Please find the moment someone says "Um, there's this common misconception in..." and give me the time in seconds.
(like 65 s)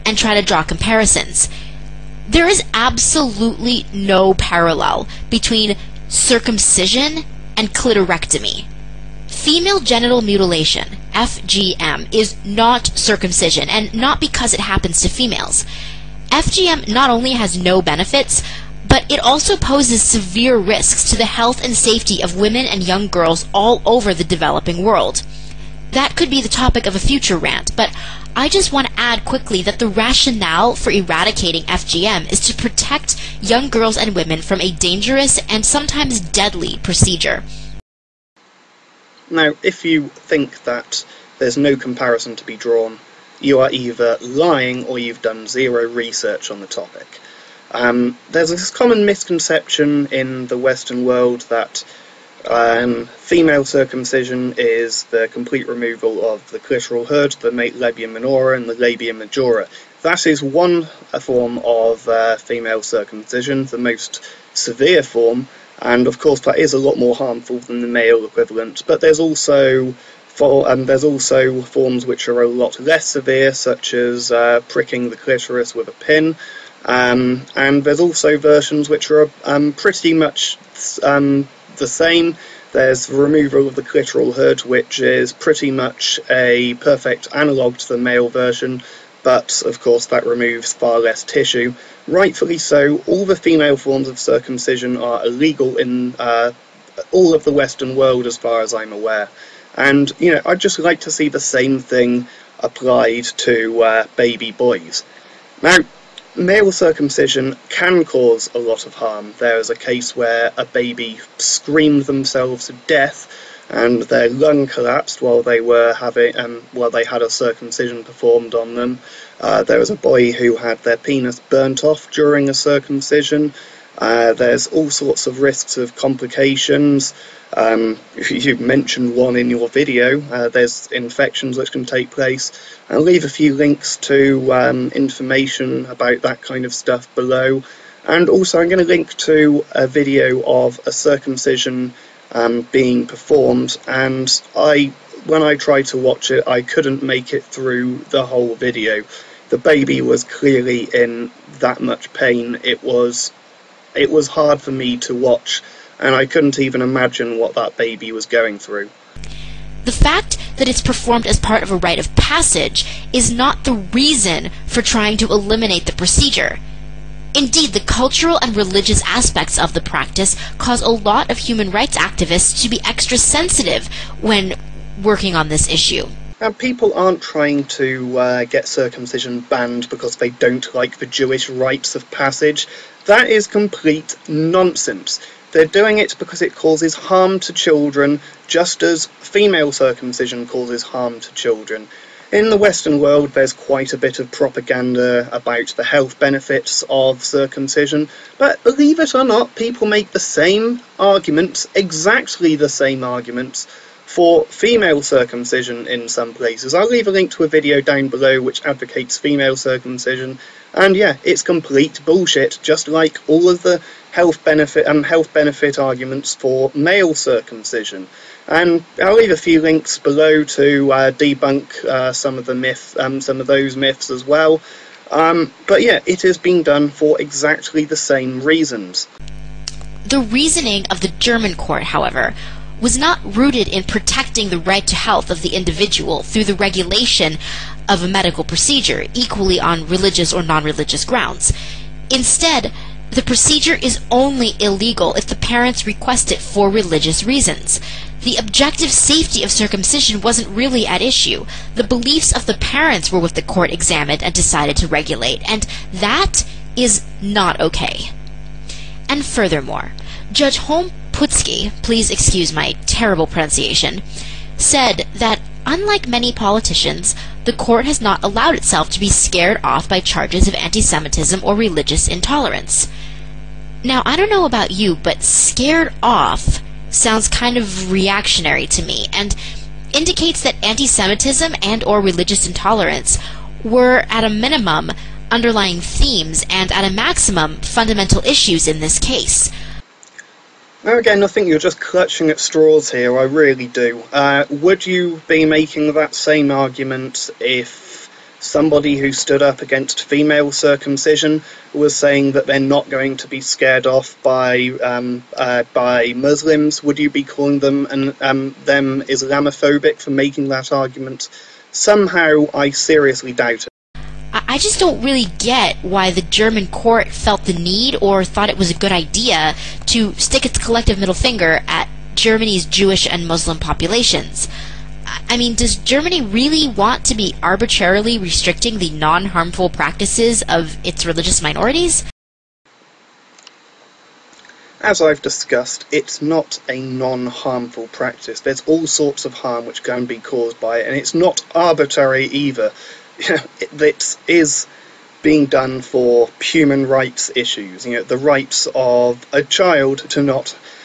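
47 s.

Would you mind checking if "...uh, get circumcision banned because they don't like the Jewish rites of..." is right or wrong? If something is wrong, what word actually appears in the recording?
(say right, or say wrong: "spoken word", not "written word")
right.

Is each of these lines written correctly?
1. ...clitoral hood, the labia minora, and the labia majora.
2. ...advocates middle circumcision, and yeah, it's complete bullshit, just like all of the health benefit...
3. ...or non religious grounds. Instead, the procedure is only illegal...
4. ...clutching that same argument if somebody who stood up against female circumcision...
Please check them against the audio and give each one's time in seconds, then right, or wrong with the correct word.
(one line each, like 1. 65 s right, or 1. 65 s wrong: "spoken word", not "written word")
1. 56 s right
2. 208 s wrong: "female", not "middle"
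3. 240 s right
4. 295 s wrong: "making", not "clutching".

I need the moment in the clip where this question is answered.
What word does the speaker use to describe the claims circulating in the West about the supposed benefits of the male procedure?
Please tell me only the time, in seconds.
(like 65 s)
194 s.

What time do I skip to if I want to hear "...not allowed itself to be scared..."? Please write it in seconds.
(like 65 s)
267 s.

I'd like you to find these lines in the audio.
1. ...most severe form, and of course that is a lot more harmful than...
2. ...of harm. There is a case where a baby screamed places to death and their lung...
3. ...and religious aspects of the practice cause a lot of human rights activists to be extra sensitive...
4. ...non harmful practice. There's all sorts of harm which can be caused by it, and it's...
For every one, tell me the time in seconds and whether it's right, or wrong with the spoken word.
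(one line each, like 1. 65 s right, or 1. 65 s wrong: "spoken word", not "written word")
1. 63 s right
2. 108 s wrong: "themselves", not "places"
3. 168 s right
4. 336 s right.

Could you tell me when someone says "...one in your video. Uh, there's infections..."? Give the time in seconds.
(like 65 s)
129 s.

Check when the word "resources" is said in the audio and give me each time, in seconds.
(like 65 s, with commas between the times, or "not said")
not said.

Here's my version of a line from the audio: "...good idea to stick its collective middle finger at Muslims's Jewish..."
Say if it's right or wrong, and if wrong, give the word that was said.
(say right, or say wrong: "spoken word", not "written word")
wrong: "Germany", not "Muslims".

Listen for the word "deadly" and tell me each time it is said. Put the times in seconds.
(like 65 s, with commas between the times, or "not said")
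36 s.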